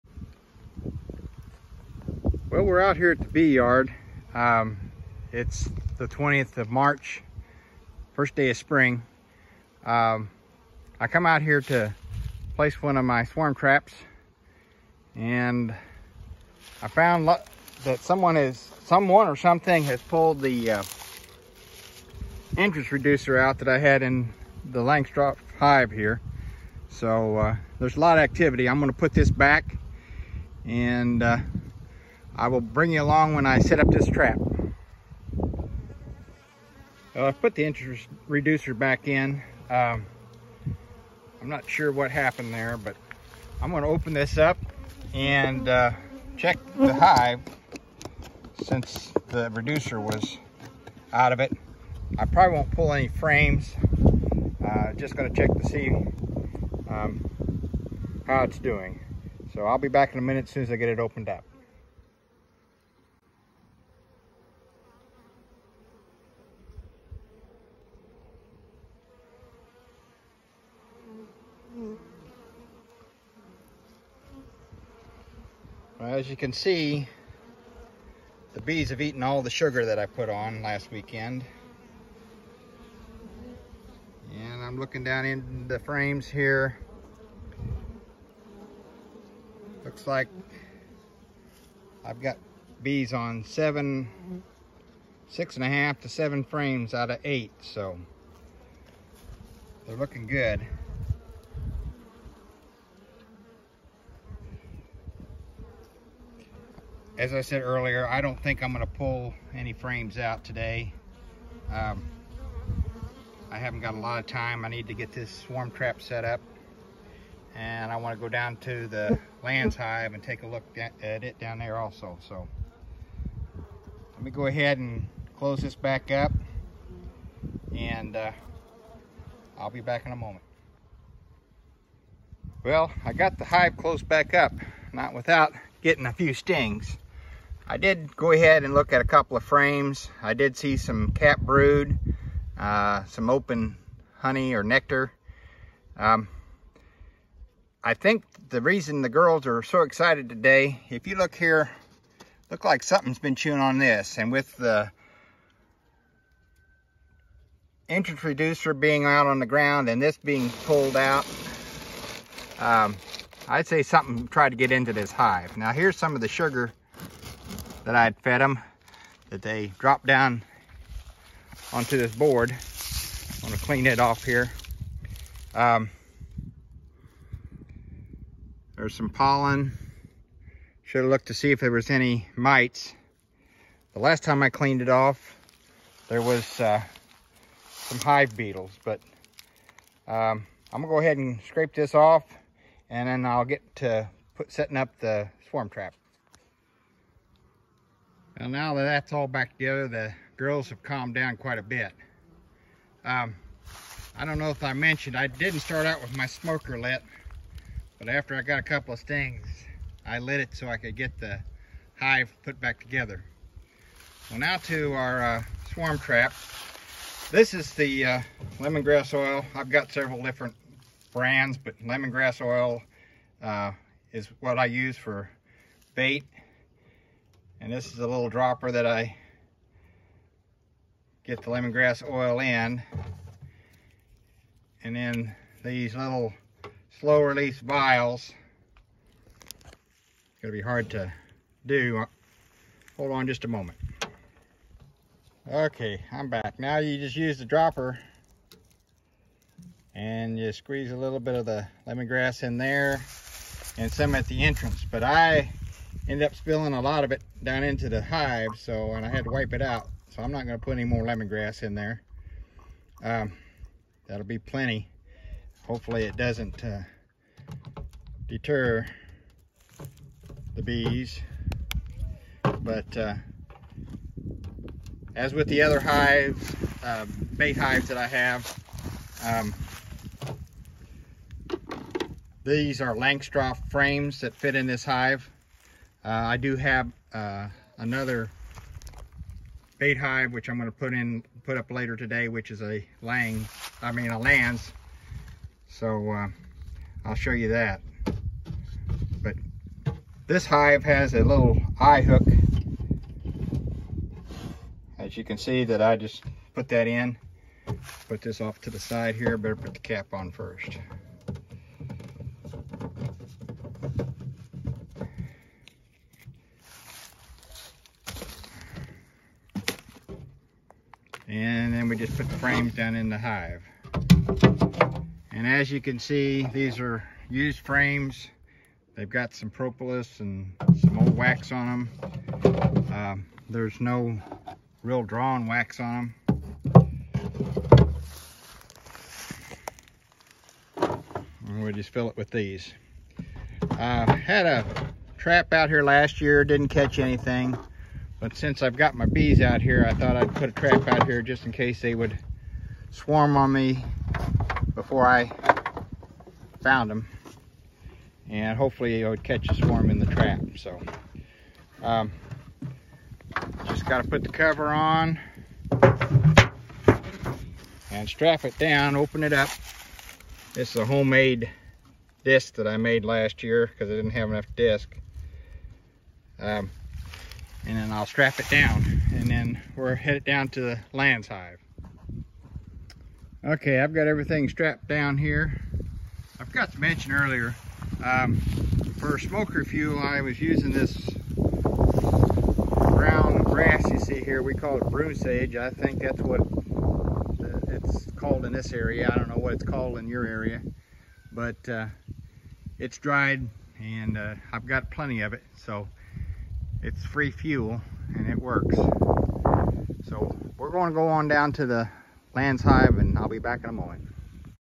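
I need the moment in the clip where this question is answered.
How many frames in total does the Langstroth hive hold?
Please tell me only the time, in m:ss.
1:37.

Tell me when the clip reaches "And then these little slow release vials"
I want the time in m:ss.
3:54.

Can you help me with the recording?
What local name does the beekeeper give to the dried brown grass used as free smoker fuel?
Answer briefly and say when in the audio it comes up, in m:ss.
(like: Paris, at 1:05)
Broom sage, at 6:34.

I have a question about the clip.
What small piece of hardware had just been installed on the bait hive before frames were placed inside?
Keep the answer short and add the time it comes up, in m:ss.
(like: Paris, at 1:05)
Eye hook, at 5:01.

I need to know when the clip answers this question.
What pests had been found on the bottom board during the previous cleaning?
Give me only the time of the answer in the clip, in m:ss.
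3:07.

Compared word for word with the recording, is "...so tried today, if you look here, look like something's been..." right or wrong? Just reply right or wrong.
wrong.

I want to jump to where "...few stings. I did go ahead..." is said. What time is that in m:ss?
2:16.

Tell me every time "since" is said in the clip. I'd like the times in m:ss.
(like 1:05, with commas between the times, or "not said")
0:48, 5:48.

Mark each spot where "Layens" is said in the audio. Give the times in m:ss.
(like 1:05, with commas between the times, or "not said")
1:59, 4:54, 6:20, 6:52.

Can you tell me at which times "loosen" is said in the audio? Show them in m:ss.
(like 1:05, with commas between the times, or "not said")
not said.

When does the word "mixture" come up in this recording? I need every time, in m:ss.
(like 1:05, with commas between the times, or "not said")
not said.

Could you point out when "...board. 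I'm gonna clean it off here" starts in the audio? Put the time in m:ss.
2:52.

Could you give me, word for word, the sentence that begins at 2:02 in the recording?
So let me go ahead and close this back up.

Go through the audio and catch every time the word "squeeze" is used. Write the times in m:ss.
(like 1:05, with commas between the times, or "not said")
4:10.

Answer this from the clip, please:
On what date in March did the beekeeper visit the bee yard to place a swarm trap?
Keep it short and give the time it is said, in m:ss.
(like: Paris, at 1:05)
20th of March, at 0:06.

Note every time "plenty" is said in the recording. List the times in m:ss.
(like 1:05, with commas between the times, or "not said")
4:24, 6:44.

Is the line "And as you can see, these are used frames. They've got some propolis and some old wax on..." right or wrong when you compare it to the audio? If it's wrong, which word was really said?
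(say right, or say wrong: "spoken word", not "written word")
right.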